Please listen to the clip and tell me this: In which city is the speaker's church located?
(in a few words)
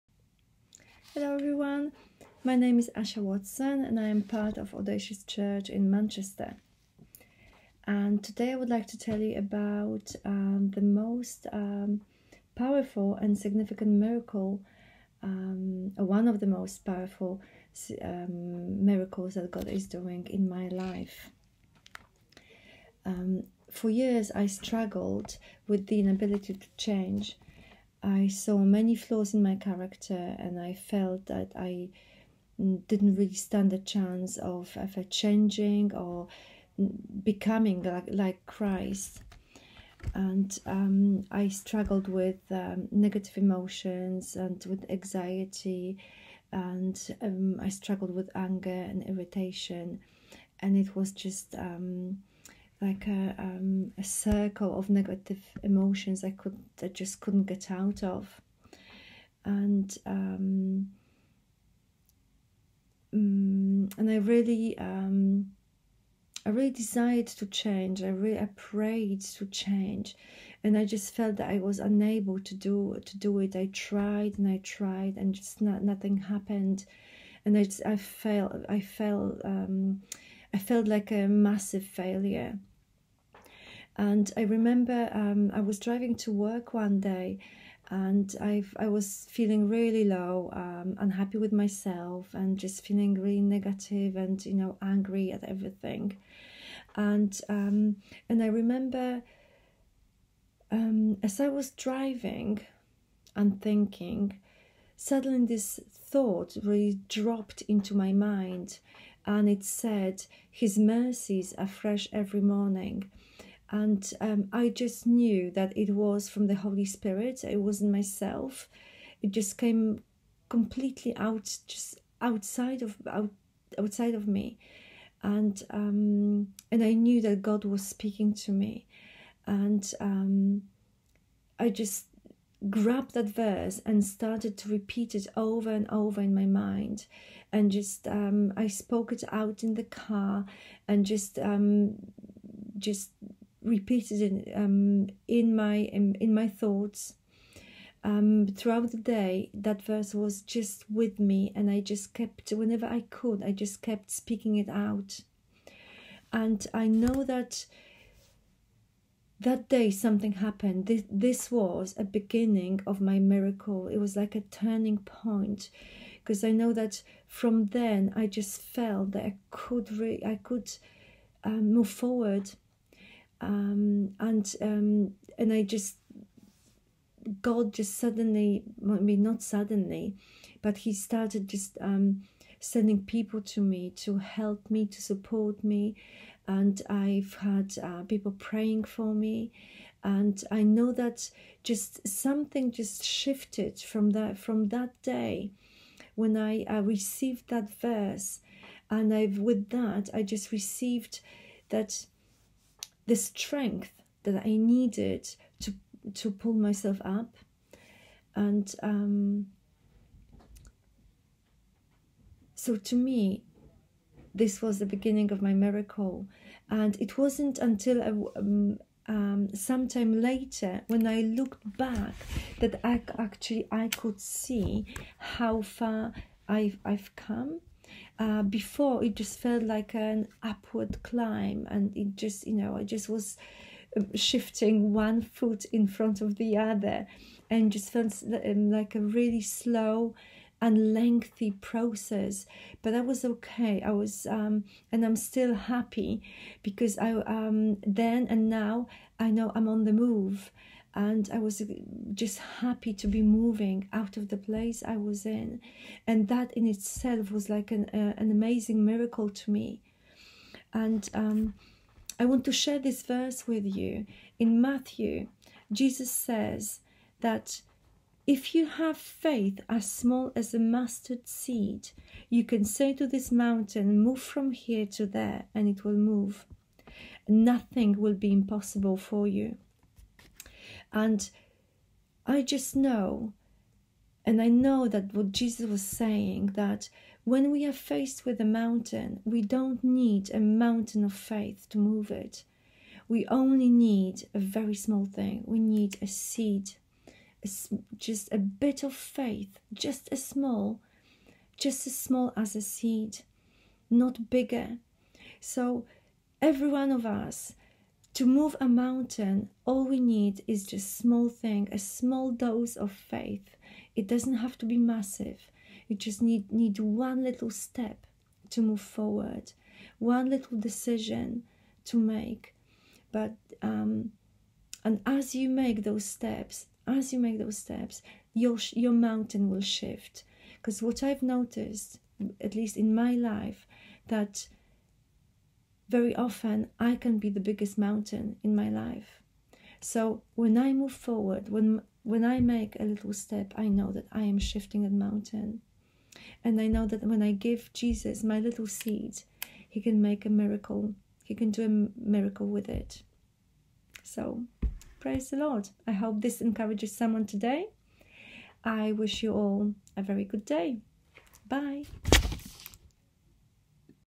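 Manchester.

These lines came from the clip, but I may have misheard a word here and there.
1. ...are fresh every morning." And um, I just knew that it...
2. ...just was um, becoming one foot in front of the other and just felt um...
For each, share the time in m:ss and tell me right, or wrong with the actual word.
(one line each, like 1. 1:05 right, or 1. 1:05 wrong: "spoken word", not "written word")
1. 1:51 right
2. 3:52 wrong: "shifting", not "becoming".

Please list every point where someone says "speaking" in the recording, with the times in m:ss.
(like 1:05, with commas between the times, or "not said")
2:07, 2:34.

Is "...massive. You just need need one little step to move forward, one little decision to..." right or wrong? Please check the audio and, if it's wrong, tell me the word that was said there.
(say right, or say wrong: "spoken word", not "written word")
right.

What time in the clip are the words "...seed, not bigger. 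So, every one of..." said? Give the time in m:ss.
5:02.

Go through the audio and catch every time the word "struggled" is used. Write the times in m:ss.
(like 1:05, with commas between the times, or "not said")
0:24, 0:41, 0:47.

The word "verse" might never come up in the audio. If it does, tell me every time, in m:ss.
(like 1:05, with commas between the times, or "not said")
2:13, 2:29, 3:17, 4:23.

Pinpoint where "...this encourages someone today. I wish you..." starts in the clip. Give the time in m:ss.
5:56.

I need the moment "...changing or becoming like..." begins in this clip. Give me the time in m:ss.
0:35.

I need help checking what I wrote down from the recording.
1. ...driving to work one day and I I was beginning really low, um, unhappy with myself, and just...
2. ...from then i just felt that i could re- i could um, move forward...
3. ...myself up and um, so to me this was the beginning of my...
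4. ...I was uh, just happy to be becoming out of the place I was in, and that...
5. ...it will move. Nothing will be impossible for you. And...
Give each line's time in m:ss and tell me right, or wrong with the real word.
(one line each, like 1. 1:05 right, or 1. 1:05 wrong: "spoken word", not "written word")
1. 1:25 wrong: "feeling", not "beginning"
2. 2:47 right
3. 3:26 right
4. 4:11 wrong: "moving", not "becoming"
5. 4:35 right.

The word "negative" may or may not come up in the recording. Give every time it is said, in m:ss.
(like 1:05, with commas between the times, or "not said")
0:42, 0:54, 1:33.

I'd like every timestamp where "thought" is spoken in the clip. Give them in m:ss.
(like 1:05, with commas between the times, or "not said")
1:45, 2:26.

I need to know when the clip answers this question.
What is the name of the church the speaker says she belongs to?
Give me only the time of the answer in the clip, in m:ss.
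0:04.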